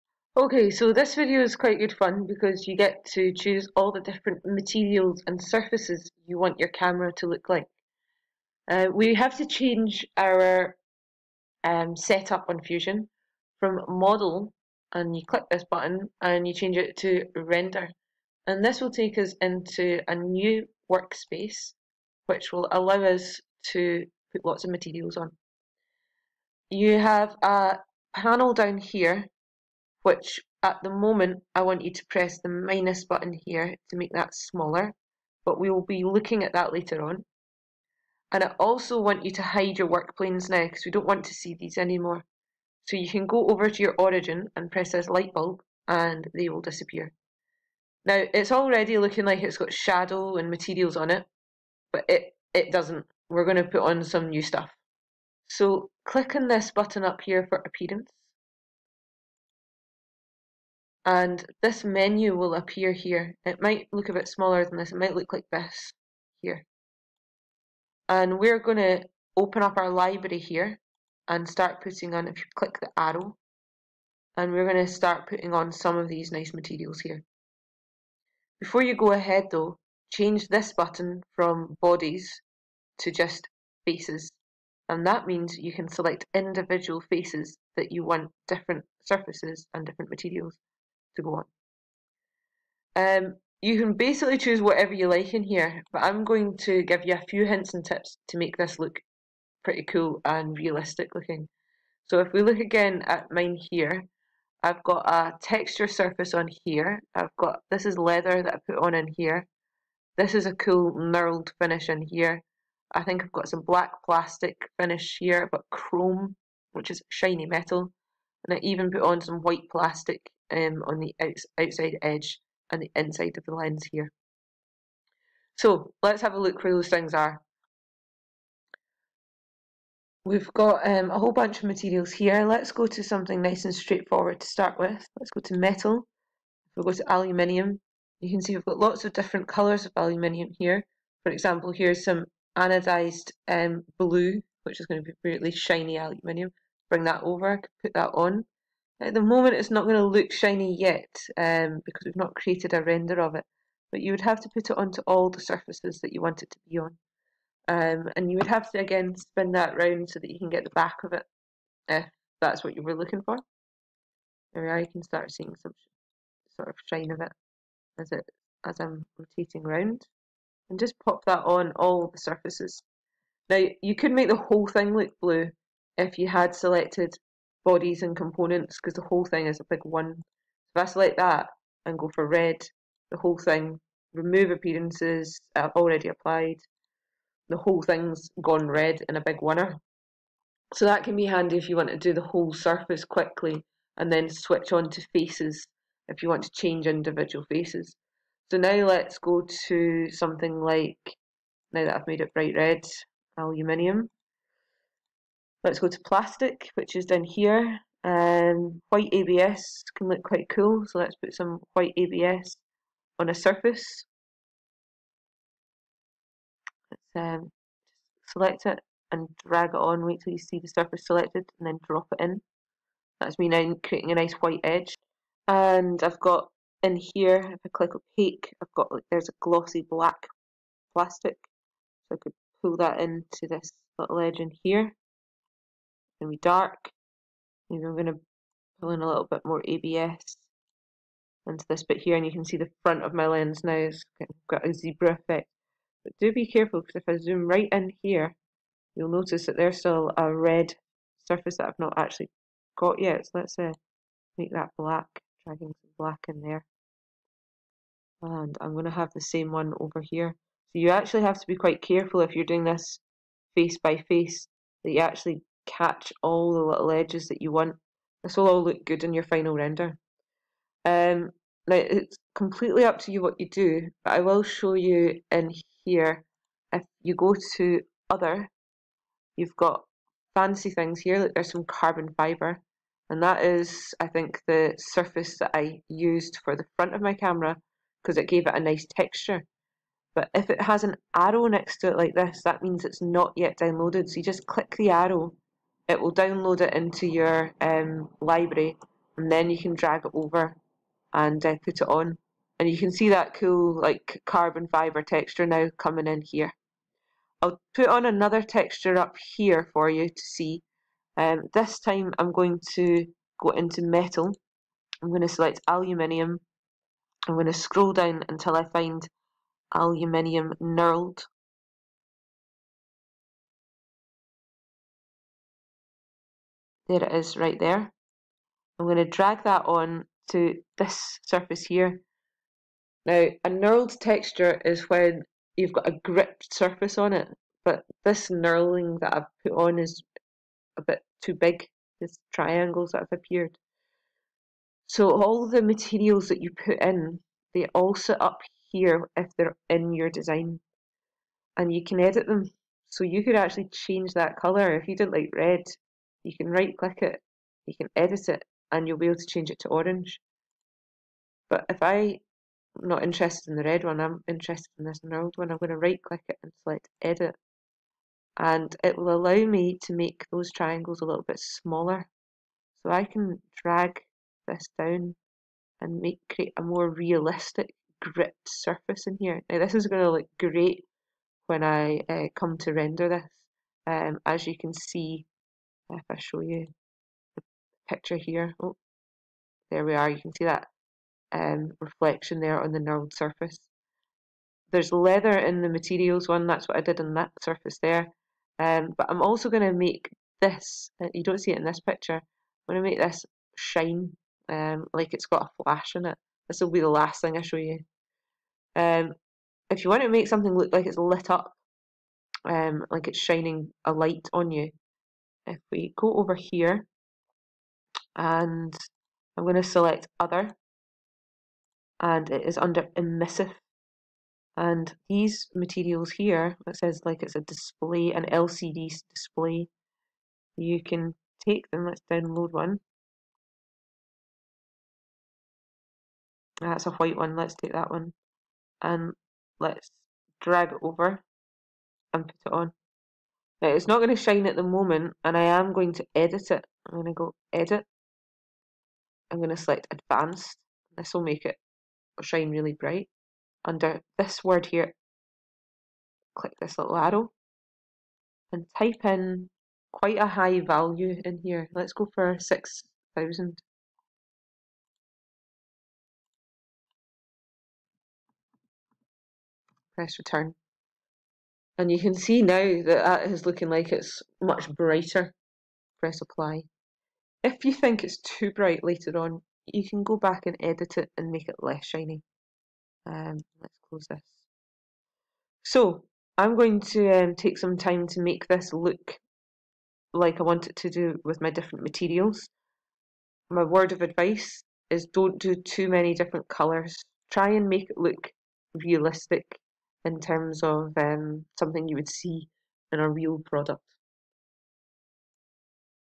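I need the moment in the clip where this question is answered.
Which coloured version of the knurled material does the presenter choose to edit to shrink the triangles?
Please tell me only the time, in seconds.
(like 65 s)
365 s.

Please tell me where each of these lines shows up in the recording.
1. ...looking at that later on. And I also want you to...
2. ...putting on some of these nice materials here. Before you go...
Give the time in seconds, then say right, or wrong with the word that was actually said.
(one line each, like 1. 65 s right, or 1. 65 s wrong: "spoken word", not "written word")
1. 36 s right
2. 75 s right.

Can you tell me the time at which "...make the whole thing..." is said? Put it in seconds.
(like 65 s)
174 s.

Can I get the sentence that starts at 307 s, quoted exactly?
I'll put on another texture up here for you to see.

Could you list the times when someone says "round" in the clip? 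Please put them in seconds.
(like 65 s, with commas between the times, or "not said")
159 s, 169 s.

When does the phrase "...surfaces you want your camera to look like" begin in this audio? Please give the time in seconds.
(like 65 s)
5 s.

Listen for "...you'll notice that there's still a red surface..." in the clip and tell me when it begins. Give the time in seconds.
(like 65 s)
248 s.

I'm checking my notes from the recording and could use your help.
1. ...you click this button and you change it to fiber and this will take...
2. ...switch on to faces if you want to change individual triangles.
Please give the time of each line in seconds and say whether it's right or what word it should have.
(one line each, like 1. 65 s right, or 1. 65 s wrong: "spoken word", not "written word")
1. 15 s wrong: "render", not "fiber"
2. 194 s wrong: "faces", not "triangles".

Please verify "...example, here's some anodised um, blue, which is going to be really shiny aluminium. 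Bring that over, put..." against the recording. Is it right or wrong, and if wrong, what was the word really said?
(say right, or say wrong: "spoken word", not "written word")
right.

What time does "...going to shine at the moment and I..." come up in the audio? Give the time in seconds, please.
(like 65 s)
443 s.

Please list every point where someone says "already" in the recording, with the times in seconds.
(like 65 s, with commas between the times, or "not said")
48 s, 185 s.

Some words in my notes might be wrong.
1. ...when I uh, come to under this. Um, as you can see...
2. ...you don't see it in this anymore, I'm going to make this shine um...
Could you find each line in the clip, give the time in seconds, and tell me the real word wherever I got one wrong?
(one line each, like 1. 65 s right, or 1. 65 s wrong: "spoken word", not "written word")
1. 381 s wrong: "render", not "under"
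2. 401 s wrong: "picture", not "anymore".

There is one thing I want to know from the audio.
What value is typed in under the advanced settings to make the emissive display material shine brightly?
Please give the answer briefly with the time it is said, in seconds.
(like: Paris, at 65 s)
6000, at 462 s.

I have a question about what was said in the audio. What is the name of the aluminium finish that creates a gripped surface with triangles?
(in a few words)
Aluminium knurled.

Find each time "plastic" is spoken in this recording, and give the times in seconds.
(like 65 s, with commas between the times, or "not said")
114 s, 119 s, 205 s, 230 s.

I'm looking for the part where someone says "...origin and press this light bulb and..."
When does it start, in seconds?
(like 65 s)
43 s.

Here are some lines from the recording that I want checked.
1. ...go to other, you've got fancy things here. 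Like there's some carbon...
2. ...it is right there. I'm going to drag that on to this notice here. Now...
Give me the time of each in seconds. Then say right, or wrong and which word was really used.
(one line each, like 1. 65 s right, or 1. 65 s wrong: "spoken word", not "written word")
1. 277 s right
2. 327 s wrong: "surface", not "notice".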